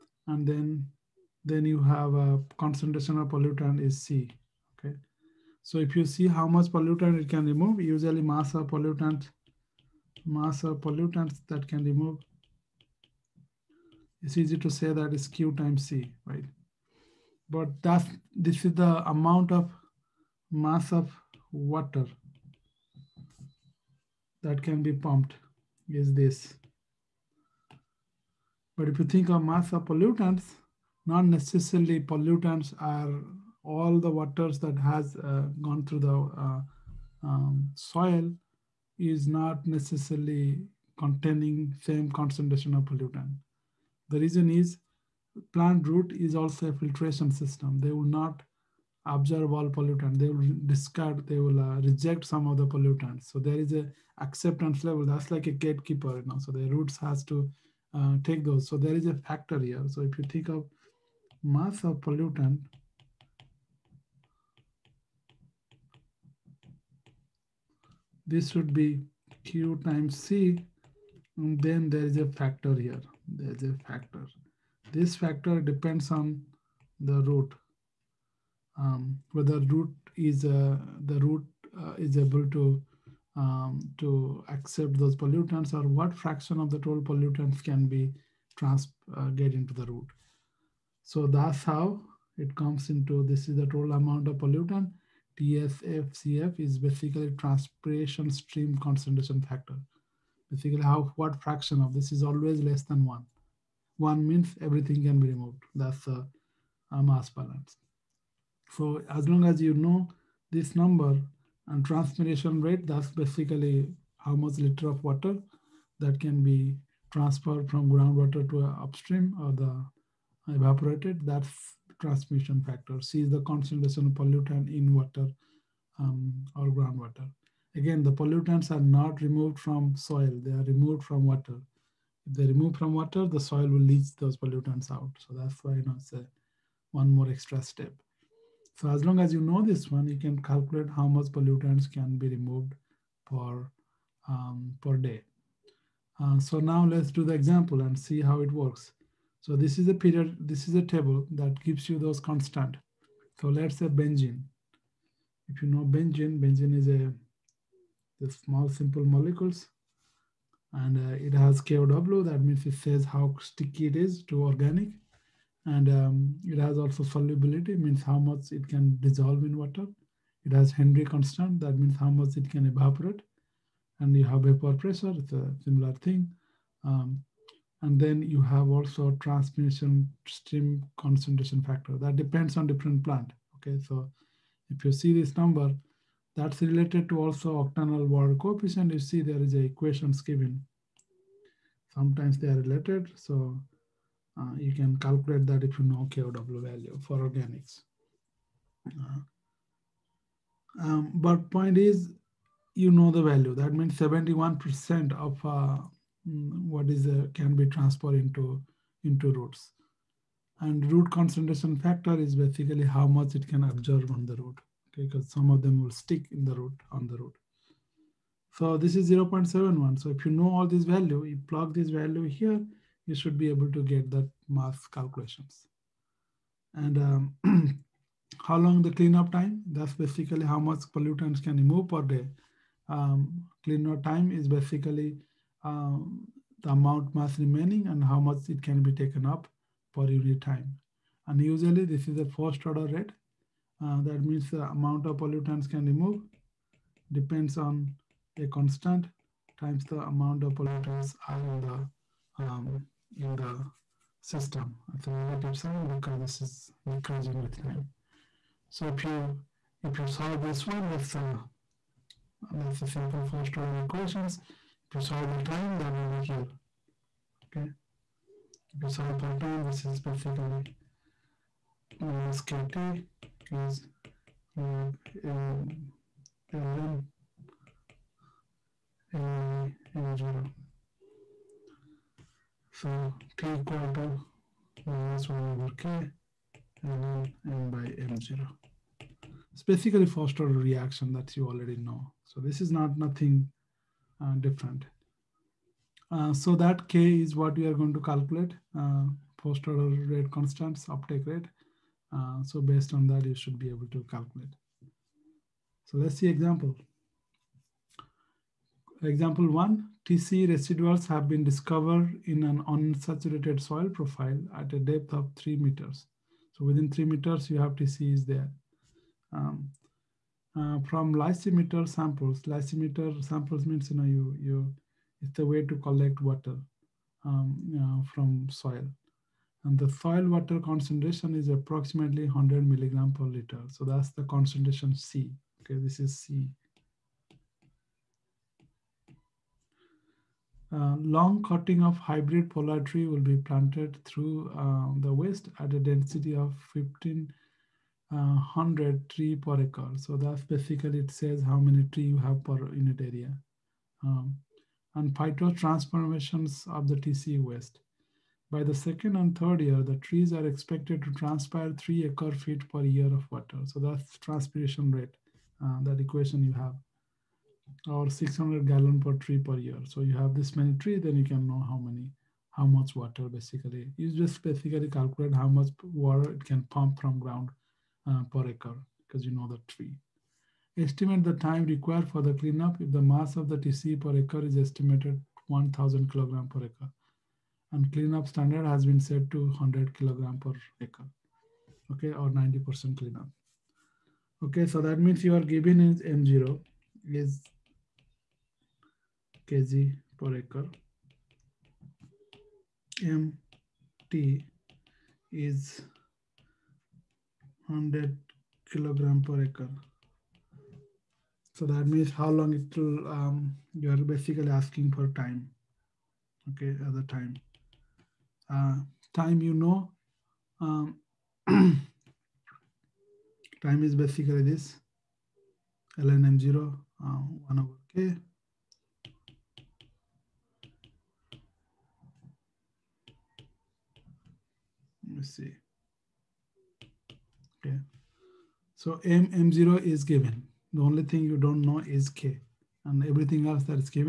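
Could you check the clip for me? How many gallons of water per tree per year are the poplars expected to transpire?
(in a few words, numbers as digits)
600 gallons.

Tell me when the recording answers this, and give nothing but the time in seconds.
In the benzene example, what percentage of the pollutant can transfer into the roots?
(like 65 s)
203 s.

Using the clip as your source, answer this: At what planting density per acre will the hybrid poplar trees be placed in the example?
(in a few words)
1500 trees per acre.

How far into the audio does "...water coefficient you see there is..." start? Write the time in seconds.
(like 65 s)
188 s.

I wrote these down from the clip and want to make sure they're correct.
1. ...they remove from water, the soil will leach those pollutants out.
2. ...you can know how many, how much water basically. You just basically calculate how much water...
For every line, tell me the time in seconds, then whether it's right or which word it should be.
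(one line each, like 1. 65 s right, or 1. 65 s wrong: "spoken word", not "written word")
1. 132 s right
2. 371 s right.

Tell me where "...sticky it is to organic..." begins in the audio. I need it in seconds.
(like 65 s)
163 s.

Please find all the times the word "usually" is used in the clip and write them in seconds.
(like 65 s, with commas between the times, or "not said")
7 s, 241 s.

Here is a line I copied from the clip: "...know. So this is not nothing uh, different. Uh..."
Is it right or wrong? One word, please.
right.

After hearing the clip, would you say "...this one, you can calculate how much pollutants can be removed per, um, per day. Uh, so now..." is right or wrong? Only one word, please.
right.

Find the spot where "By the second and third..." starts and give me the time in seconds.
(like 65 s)
358 s.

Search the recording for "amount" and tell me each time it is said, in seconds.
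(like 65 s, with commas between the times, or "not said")
19 s, 93 s, 236 s, 244 s, 249 s.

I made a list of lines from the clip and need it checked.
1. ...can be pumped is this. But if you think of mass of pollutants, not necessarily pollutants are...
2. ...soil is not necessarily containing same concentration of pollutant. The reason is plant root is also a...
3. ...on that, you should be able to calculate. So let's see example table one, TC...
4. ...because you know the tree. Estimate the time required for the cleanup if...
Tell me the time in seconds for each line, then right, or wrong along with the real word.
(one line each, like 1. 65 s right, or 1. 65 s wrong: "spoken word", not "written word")
1. 24 s right
2. 37 s right
3. 302 s wrong: "example", not "table"
4. 379 s right.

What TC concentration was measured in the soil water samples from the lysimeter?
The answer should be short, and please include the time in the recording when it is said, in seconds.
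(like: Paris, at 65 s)
100 milligram per liter, at 332 s.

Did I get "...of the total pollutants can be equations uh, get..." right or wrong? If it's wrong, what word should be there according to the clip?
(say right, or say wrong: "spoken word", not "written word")
wrong: "trans", not "equations".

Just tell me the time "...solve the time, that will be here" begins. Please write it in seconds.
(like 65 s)
265 s.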